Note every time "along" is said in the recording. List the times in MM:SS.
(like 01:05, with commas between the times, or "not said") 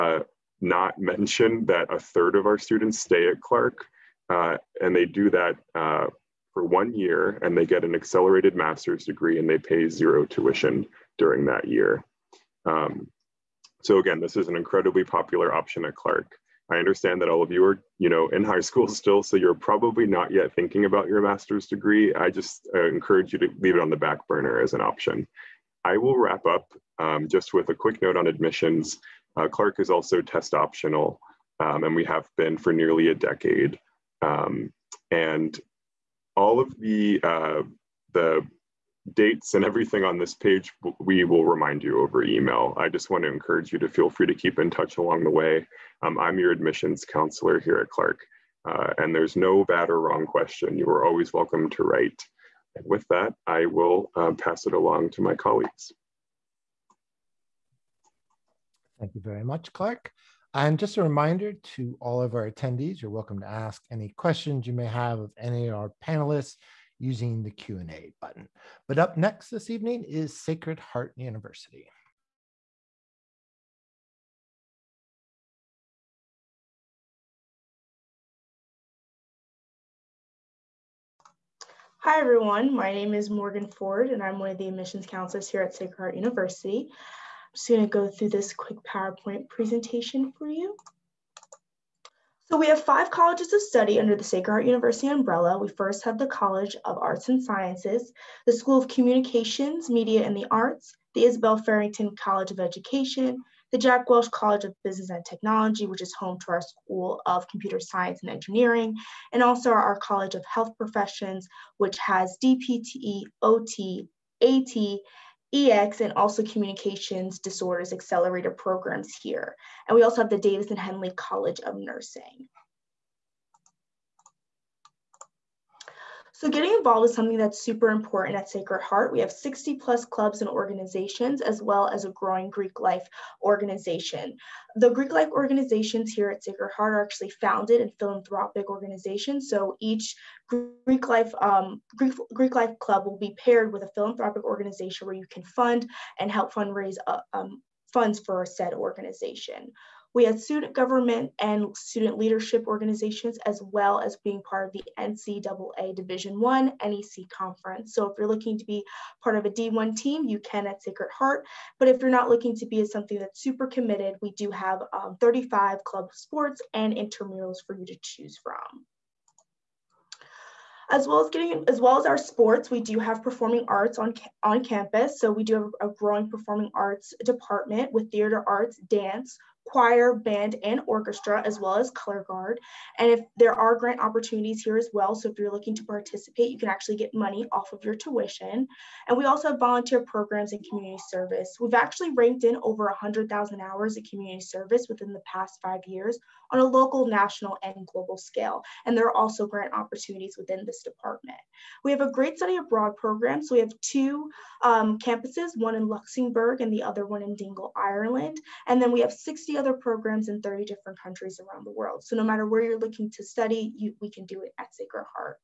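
00:44, 00:54.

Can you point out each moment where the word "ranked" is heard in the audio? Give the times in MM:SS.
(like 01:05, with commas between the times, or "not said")
03:12.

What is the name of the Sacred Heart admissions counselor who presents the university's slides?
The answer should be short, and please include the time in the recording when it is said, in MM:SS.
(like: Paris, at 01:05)
Morgan Ford, at 01:23.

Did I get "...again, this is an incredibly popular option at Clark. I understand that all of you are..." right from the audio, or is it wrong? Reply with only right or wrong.
right.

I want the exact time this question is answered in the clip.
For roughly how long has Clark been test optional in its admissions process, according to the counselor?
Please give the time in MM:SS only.
00:32.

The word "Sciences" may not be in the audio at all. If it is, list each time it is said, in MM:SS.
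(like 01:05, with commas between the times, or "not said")
01:37, 01:47.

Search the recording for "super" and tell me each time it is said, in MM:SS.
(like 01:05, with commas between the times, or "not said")
02:07, 02:43.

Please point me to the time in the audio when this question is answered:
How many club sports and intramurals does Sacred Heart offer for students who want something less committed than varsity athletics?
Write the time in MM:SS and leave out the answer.
02:45.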